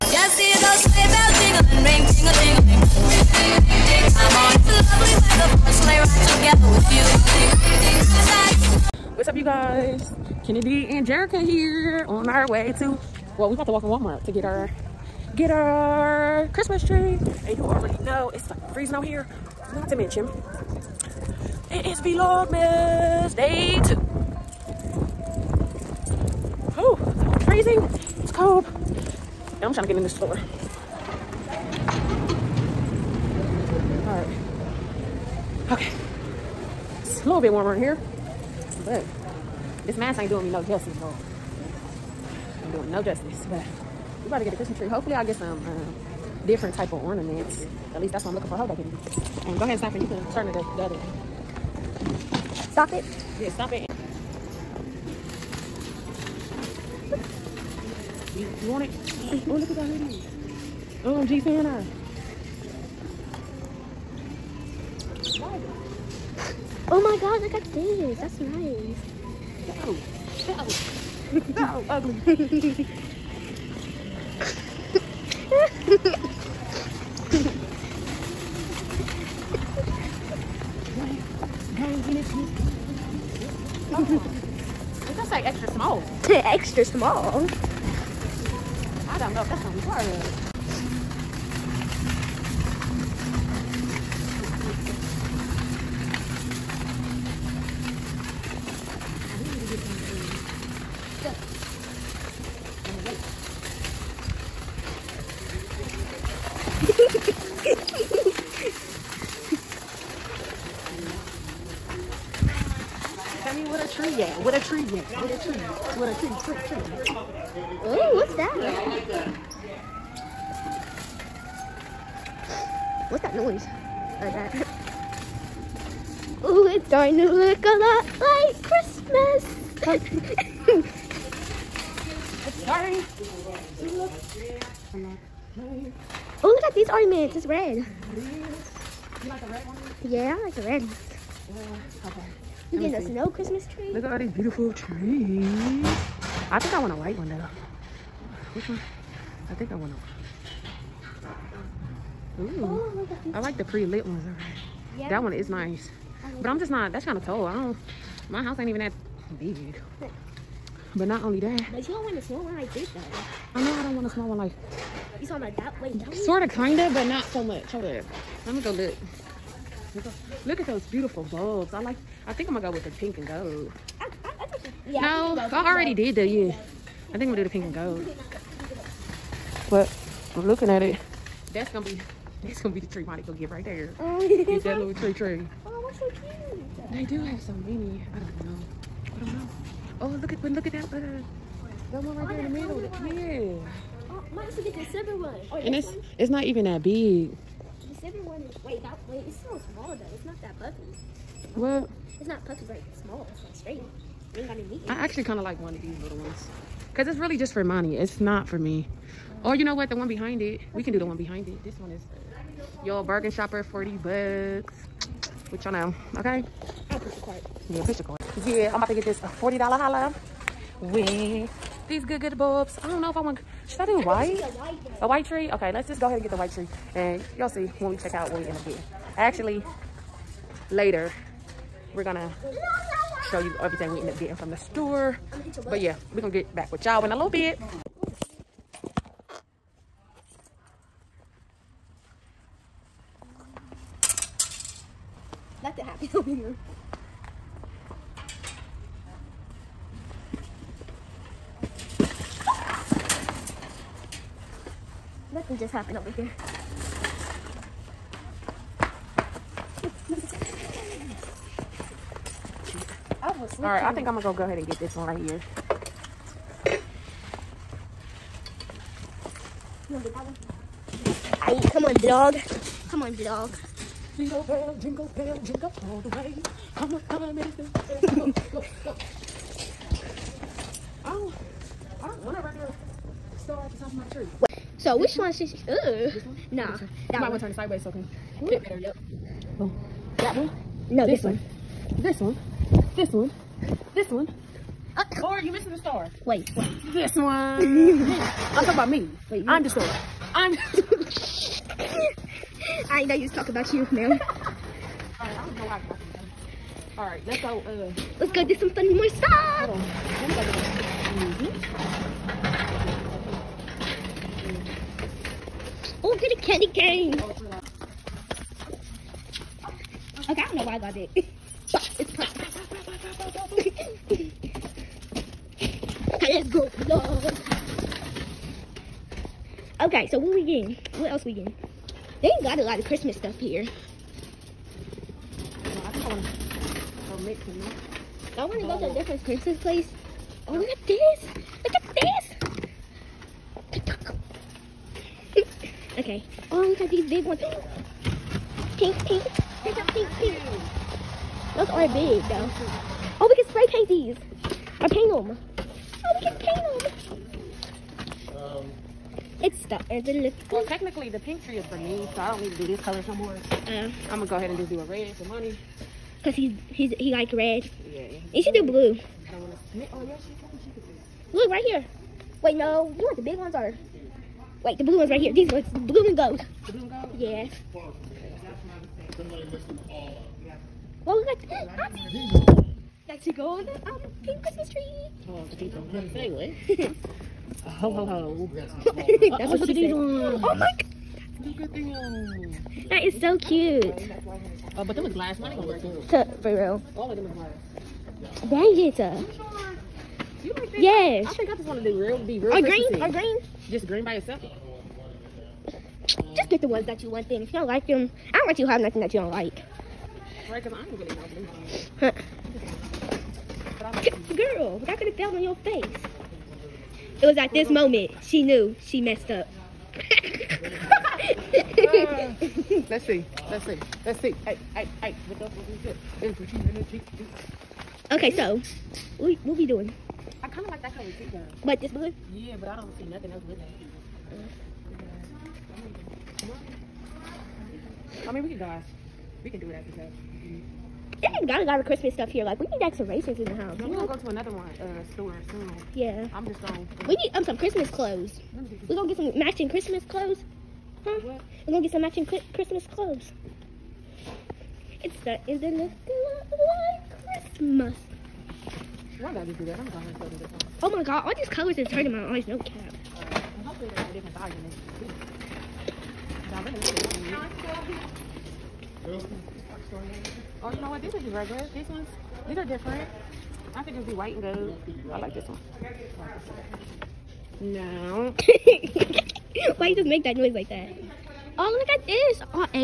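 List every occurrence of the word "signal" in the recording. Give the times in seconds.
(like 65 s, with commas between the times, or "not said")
not said.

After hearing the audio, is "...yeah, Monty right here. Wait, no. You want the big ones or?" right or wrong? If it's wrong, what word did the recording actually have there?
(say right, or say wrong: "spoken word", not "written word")
wrong: "Look", not "Monty".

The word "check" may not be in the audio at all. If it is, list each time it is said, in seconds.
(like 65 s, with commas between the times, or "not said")
227 s.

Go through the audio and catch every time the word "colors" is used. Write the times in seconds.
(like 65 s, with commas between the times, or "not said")
362 s, 430 s, 461 s.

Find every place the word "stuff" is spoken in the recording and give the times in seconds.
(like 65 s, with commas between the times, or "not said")
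309 s, 333 s, 442 s.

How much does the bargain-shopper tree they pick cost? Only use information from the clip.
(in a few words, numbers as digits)
$40.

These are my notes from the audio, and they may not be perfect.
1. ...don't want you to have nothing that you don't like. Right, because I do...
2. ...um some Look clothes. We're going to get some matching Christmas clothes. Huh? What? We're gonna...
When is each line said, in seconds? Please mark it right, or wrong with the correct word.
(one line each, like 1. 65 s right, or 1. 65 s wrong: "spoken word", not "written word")
1. 408 s right
2. 447 s wrong: "Christmas", not "Look".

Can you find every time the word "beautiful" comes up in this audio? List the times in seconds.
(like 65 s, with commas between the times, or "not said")
144 s, 170 s.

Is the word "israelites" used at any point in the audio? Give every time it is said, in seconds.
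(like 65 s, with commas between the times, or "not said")
not said.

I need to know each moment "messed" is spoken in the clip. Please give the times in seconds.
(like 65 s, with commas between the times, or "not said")
419 s.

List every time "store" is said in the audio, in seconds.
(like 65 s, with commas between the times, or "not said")
30 s, 234 s, 445 s.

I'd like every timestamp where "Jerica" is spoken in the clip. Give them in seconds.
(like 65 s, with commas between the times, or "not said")
11 s.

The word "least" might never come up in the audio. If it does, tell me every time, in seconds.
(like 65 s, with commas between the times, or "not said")
47 s.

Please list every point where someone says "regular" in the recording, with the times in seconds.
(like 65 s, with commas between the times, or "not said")
282 s, 471 s.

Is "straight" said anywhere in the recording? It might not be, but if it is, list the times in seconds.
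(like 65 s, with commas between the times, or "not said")
203 s.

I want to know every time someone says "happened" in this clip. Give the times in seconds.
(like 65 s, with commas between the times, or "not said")
245 s, 255 s.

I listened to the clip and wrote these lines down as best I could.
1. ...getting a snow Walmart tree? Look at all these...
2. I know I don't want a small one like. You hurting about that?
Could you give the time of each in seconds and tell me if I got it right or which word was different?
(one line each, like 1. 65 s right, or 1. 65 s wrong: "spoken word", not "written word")
1. 142 s wrong: "Christmas", not "Walmart"
2. 163 s wrong: "talking", not "hurting".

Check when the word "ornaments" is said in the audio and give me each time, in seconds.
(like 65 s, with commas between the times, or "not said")
47 s, 136 s.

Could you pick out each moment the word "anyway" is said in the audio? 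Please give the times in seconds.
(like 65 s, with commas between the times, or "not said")
386 s.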